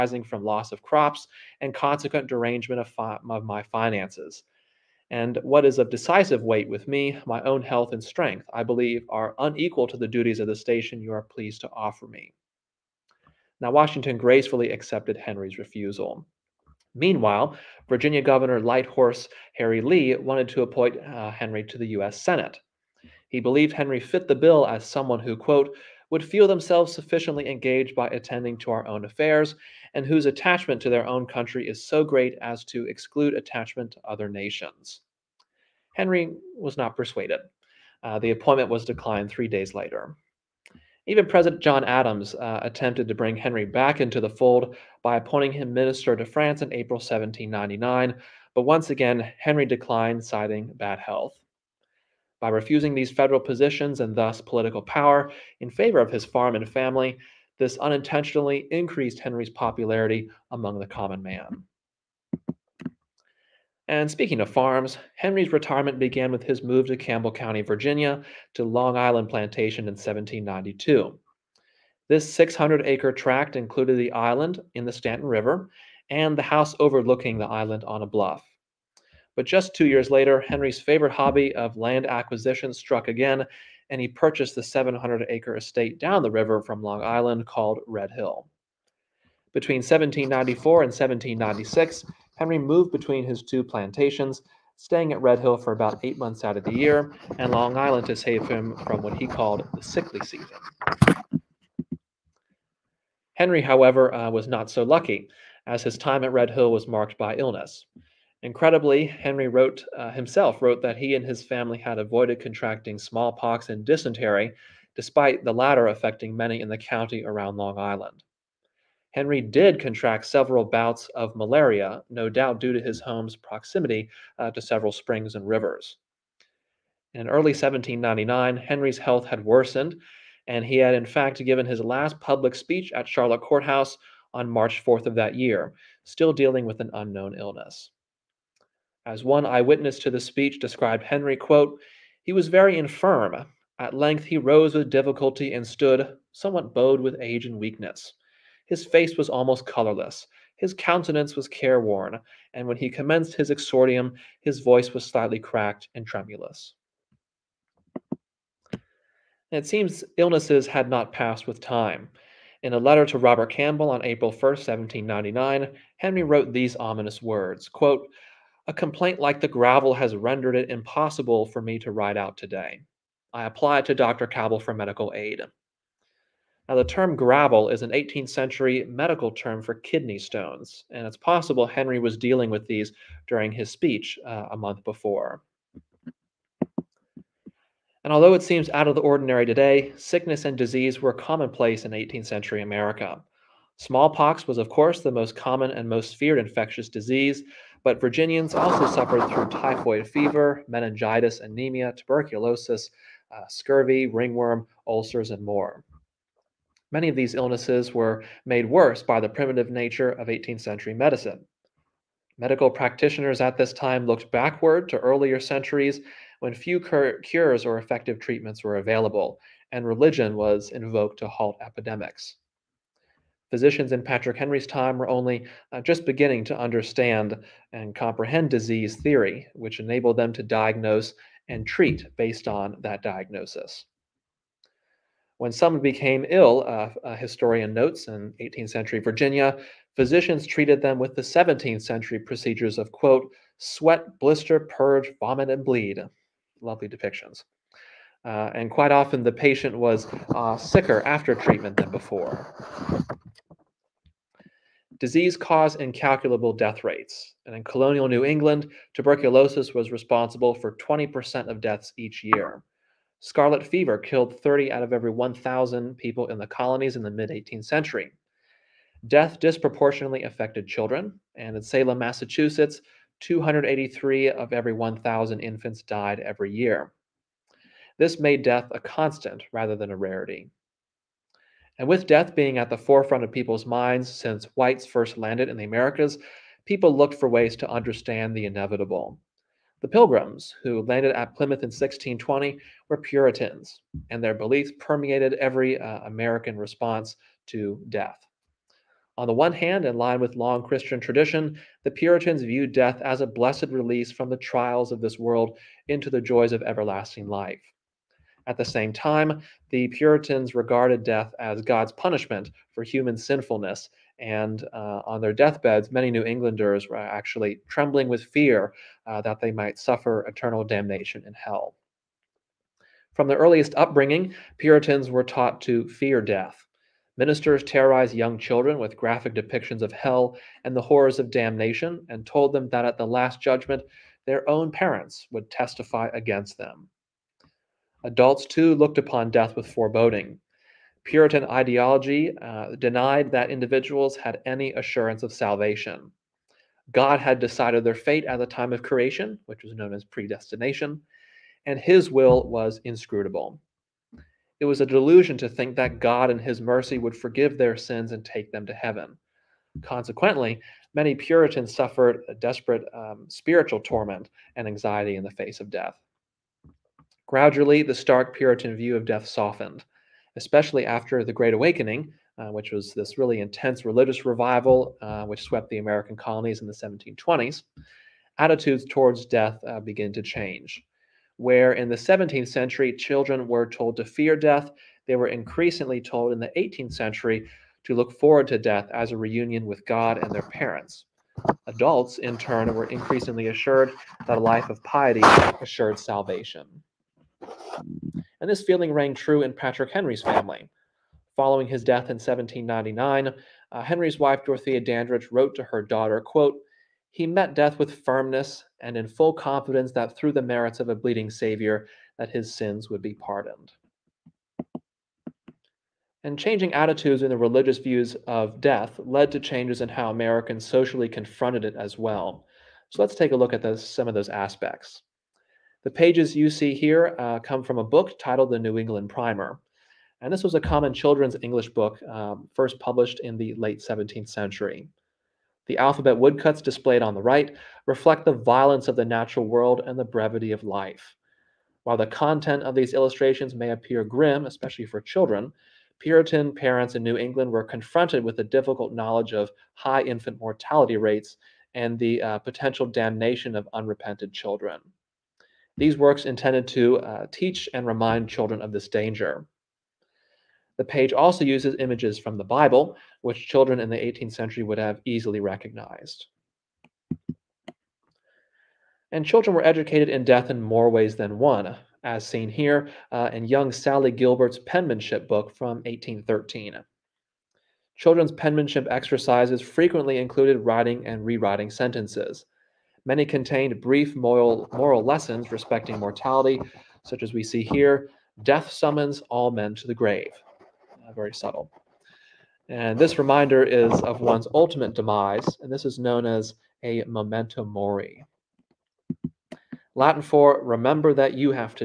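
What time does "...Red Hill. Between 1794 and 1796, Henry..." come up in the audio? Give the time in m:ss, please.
1:27.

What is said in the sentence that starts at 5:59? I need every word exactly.
Consequently, many Puritans suffered a desperate um, spiritual torment and anxiety in the face of death.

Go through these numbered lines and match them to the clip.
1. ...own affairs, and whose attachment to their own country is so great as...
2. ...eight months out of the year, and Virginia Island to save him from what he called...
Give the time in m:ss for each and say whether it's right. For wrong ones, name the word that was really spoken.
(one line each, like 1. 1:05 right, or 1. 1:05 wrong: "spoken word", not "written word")
1. 0:28 right
2. 1:36 wrong: "Long", not "Virginia".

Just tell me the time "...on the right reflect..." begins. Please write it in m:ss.
7:17.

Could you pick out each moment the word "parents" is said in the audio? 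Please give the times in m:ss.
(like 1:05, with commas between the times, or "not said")
5:34, 6:30, 7:26.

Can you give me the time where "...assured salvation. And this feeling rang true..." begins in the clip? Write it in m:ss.
6:35.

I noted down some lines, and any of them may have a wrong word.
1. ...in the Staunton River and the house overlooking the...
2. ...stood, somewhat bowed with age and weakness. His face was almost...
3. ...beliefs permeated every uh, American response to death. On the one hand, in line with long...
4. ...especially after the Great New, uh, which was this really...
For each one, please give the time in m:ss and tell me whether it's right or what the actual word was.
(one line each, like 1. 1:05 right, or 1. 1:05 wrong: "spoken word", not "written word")
1. 1:14 right
2. 2:25 right
3. 4:54 right
4. 6:10 wrong: "Awakening", not "New".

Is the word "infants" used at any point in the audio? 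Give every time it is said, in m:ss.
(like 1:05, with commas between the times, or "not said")
4:35, 7:30.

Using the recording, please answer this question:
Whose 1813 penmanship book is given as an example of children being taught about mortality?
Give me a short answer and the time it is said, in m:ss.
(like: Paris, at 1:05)
Sally Gilbert, at 7:53.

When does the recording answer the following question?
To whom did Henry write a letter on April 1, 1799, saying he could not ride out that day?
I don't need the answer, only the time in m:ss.
2:43.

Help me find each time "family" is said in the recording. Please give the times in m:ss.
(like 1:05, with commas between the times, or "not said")
0:56, 1:51, 6:40.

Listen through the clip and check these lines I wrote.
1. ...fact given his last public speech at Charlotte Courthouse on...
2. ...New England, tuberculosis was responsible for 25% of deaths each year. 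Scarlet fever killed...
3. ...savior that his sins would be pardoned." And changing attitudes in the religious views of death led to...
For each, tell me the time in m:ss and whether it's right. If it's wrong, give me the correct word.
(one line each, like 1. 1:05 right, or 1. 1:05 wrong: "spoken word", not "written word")
1. 2:11 right
2. 4:18 wrong: "20", not "25"
3. 6:51 right.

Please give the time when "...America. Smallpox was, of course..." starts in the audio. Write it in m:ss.
3:12.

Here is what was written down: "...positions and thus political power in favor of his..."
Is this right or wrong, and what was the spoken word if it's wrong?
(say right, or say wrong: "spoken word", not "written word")
right.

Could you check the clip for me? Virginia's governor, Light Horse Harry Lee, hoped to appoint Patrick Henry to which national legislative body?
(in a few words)
U.S. Senate.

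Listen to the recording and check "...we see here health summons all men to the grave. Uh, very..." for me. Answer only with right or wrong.
wrong.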